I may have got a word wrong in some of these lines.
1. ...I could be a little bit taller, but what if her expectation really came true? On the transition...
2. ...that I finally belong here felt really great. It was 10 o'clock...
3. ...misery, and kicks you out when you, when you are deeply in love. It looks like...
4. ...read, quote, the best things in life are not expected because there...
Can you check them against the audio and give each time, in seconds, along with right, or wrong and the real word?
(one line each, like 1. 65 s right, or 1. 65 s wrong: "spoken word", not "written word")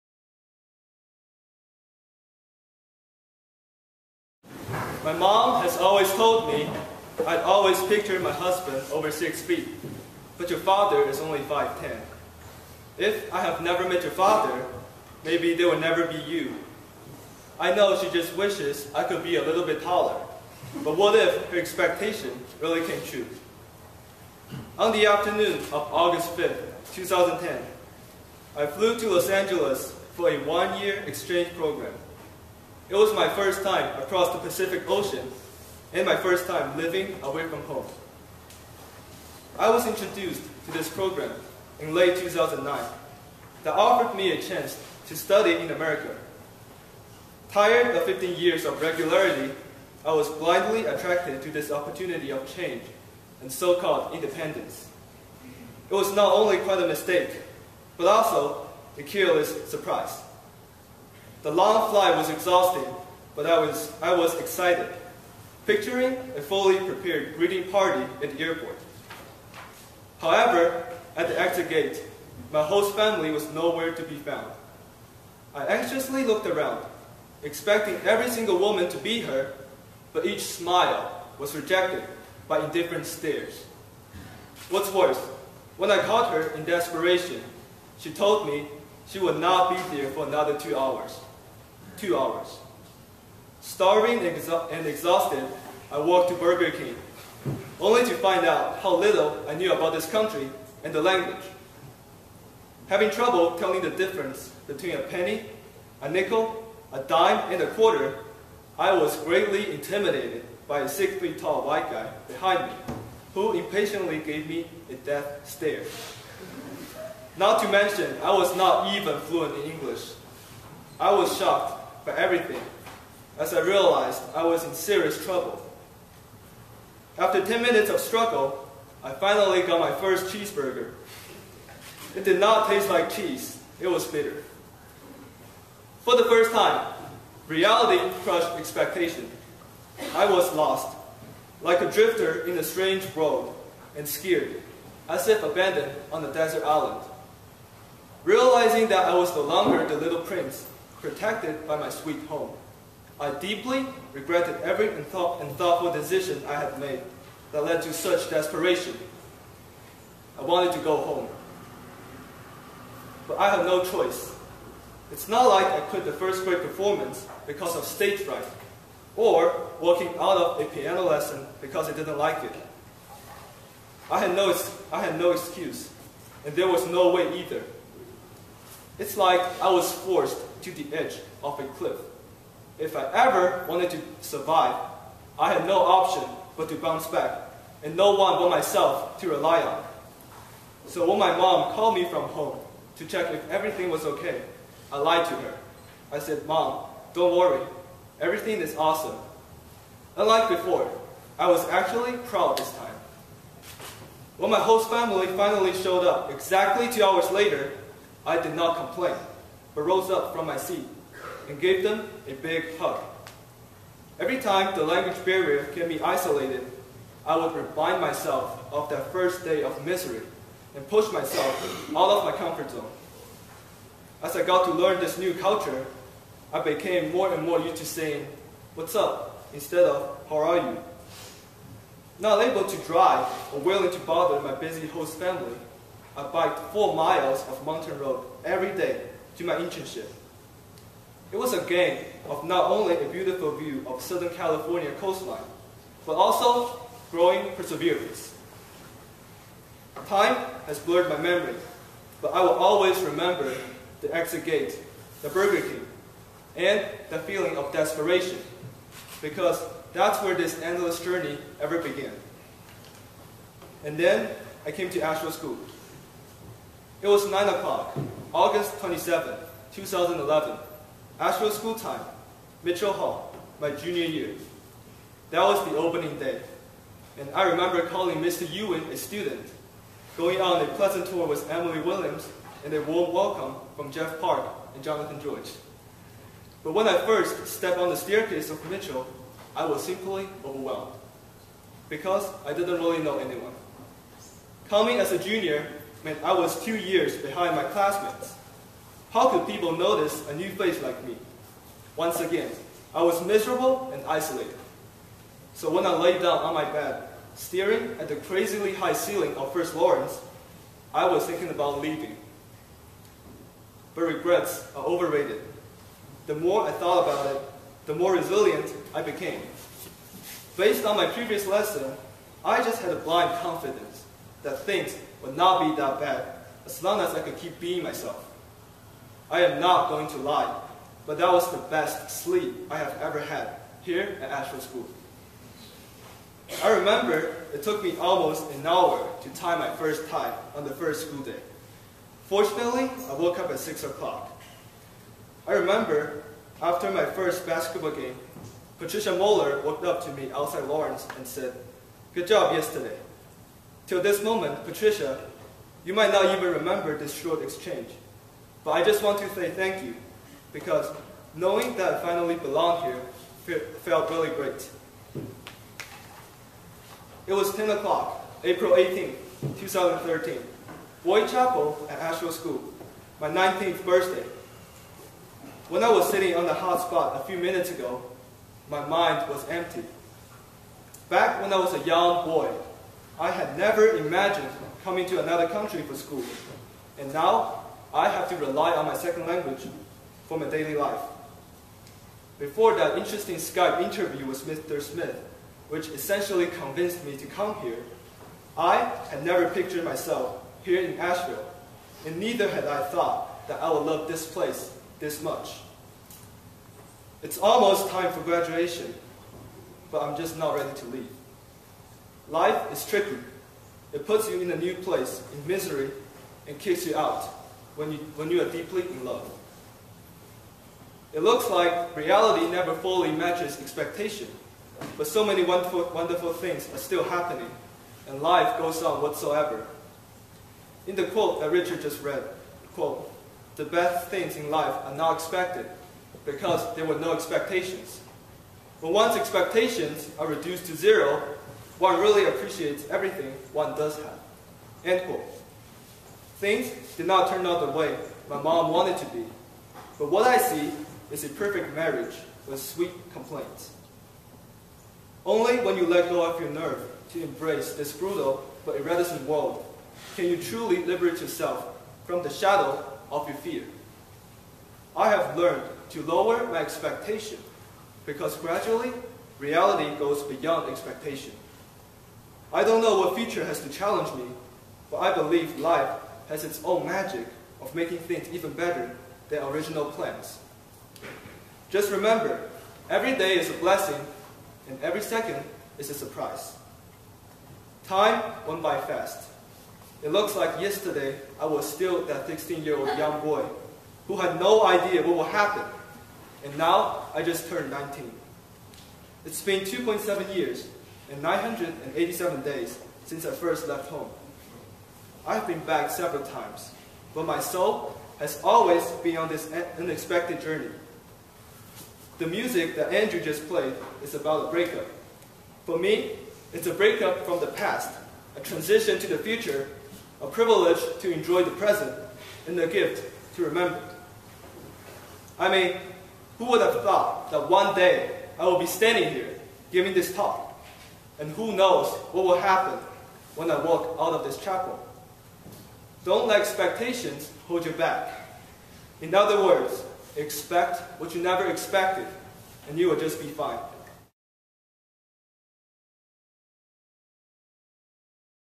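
1. 18 s wrong: "afternoon", not "transition"
2. 361 s right
3. 415 s right
4. 432 s right.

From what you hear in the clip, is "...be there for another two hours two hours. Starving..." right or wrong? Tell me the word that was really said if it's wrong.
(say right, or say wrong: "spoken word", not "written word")
right.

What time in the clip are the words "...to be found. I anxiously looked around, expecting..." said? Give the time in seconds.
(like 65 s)
73 s.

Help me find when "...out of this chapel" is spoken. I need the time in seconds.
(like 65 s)
533 s.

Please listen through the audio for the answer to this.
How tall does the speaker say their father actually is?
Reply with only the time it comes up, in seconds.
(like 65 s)
11 s.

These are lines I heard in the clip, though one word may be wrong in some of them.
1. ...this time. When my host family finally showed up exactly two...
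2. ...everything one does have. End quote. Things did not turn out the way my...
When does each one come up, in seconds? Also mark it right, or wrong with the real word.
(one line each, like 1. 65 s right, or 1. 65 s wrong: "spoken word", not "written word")
1. 202 s right
2. 442 s right.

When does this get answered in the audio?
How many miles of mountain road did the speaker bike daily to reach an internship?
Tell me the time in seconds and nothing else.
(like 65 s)
236 s.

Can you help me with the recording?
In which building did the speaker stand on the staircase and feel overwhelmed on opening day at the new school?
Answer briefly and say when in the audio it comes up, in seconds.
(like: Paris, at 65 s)
Mitchell Hall, at 272 s.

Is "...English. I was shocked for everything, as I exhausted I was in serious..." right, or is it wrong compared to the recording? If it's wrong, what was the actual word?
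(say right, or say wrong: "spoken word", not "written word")
wrong: "realized", not "exhausted".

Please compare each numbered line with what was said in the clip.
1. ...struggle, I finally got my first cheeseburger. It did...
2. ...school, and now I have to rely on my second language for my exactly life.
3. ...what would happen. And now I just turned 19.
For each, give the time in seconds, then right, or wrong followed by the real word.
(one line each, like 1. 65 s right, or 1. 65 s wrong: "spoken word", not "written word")
1. 127 s right
2. 385 s wrong: "daily", not "exactly"
3. 495 s right.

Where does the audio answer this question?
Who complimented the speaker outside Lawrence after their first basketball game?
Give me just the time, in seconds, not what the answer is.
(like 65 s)
348 s.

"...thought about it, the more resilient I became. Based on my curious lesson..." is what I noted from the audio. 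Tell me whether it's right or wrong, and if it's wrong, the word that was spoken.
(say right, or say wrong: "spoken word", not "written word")
wrong: "previous", not "curious".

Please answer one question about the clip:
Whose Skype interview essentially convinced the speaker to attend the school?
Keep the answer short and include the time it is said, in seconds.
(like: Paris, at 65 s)
Mr. Smith, at 394 s.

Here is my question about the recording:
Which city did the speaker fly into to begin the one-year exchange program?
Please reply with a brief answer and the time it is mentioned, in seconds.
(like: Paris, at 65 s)
Los Angeles, at 29 s.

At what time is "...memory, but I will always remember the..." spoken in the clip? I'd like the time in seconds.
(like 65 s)
251 s.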